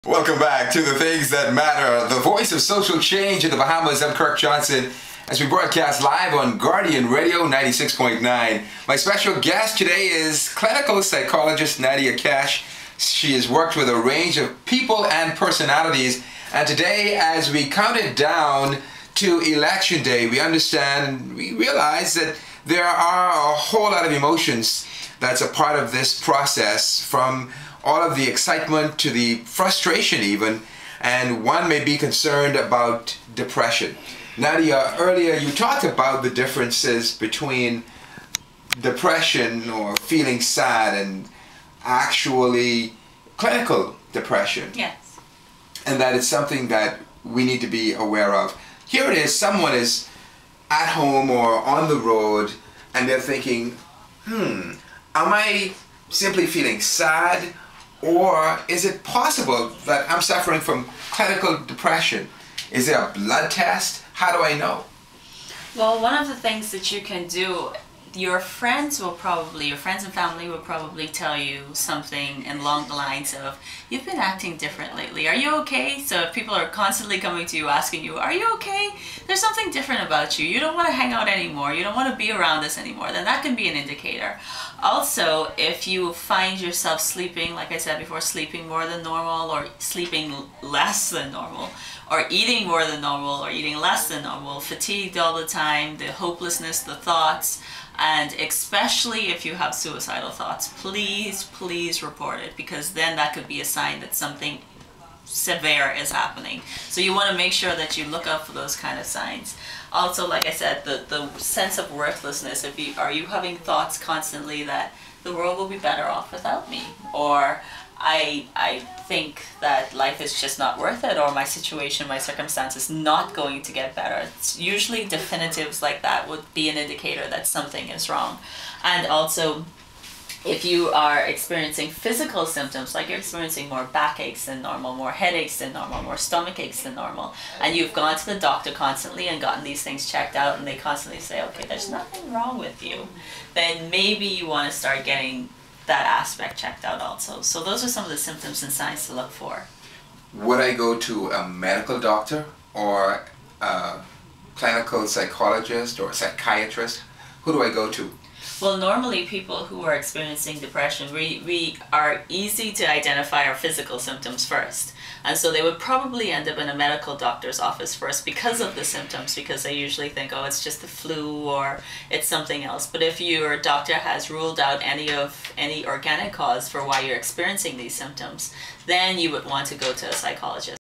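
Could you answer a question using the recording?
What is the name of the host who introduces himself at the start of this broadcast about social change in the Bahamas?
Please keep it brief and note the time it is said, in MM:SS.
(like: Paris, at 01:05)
Kirk Johnson, at 00:04.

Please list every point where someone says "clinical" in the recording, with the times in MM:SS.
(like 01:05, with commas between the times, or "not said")
00:10, 00:43, 01:01, 02:34.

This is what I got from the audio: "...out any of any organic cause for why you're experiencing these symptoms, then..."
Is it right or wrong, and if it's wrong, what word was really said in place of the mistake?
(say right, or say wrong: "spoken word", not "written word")
right.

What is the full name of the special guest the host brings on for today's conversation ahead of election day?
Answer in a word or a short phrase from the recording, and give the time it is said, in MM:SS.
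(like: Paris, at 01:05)
Nadia Cash, at 00:11.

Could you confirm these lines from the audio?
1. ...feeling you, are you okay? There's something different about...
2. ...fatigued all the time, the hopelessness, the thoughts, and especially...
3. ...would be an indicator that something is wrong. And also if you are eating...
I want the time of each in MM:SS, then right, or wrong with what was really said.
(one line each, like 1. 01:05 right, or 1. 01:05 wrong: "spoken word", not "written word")
1. 01:17 wrong: "asking", not "feeling"
2. 01:34 right
3. 02:06 wrong: "experiencing", not "eating".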